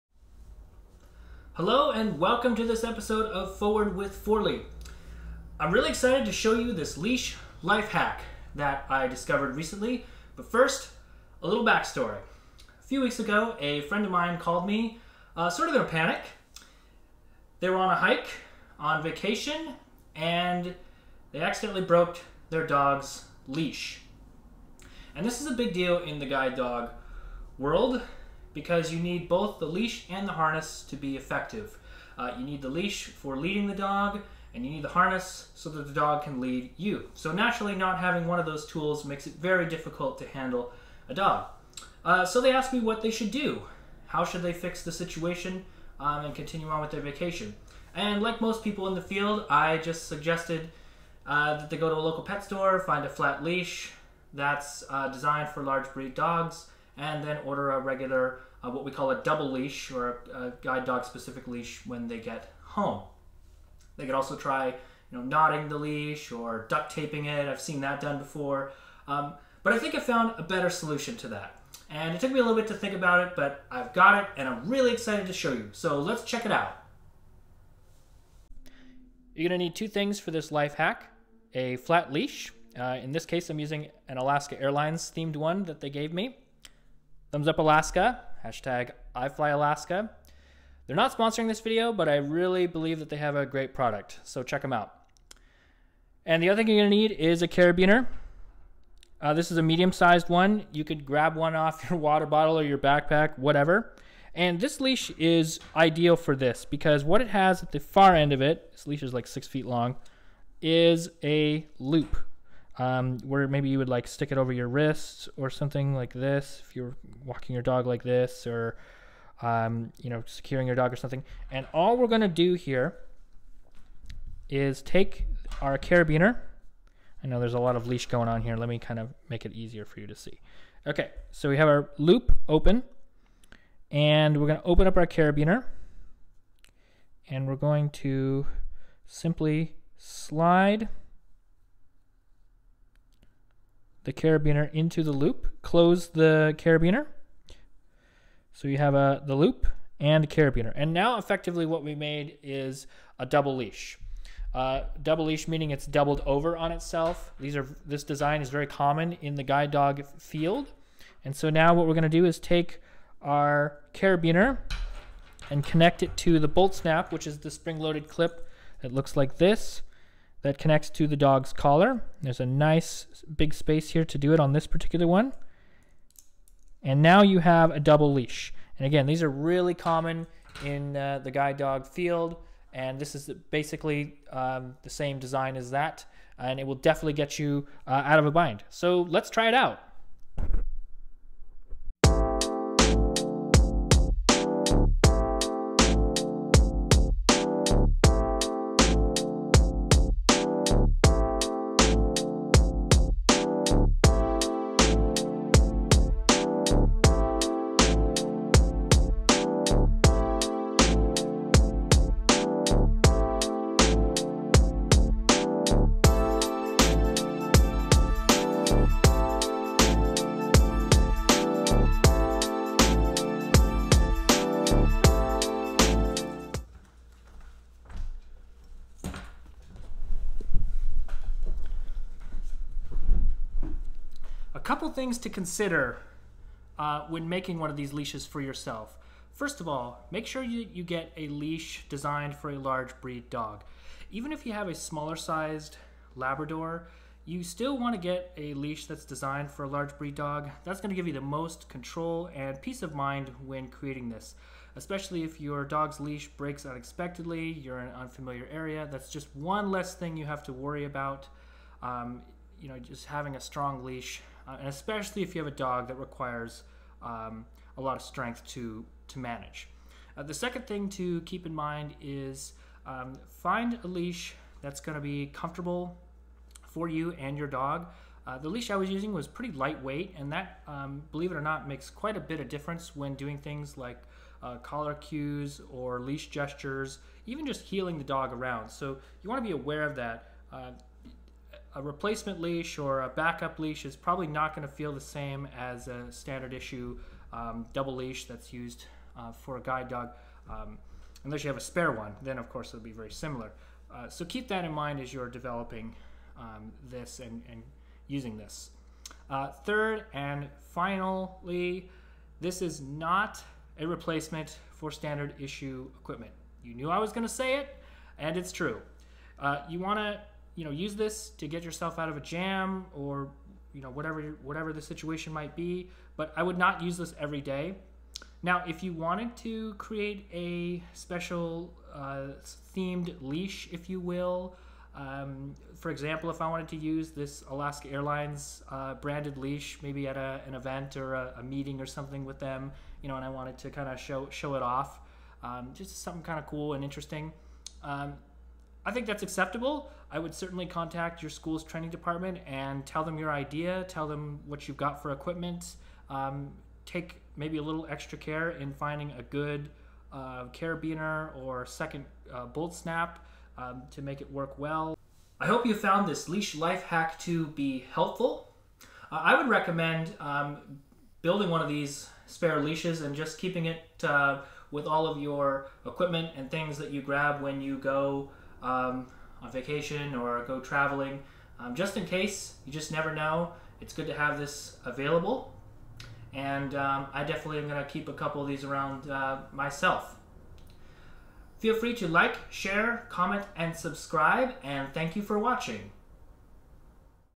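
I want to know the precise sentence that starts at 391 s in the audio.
Feel free to like, share, comment, and subscribe.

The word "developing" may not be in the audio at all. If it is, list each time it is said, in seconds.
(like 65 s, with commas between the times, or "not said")
305 s.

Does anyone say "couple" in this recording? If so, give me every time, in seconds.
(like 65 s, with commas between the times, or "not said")
234 s, 388 s.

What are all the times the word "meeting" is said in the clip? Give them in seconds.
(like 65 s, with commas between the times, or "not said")
341 s.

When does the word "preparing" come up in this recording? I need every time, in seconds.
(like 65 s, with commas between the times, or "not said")
not said.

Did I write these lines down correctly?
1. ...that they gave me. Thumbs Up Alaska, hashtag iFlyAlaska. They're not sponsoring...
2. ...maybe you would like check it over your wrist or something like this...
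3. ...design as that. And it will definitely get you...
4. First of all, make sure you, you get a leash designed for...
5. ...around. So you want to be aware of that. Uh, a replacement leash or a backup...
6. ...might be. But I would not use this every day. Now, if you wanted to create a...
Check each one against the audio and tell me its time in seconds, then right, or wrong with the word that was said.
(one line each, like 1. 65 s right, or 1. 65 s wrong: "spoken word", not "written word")
1. 85 s right
2. 113 s wrong: "stick", not "check"
3. 185 s right
4. 239 s right
5. 288 s right
6. 325 s right.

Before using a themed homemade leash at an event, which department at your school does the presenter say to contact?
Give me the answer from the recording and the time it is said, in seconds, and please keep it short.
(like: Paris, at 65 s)
training department, at 351 s.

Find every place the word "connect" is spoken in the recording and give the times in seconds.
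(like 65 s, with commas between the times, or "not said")
165 s, 170 s.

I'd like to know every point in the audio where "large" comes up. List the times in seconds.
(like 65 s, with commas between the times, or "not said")
55 s, 242 s, 249 s.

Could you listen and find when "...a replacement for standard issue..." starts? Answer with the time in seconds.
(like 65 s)
313 s.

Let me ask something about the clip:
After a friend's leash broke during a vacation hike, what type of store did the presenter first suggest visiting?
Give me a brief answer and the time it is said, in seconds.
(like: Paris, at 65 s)
pet store, at 52 s.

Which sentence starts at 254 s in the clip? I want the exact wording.
Especially if your dog's leash breaks unexpectedly, you're in an unfamiliar area, that's just one less thing you have to worry about.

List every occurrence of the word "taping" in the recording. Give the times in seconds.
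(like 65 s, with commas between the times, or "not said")
66 s.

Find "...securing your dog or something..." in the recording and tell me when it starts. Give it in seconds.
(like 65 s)
120 s.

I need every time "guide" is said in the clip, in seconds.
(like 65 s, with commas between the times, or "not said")
26 s, 60 s, 159 s, 181 s, 299 s.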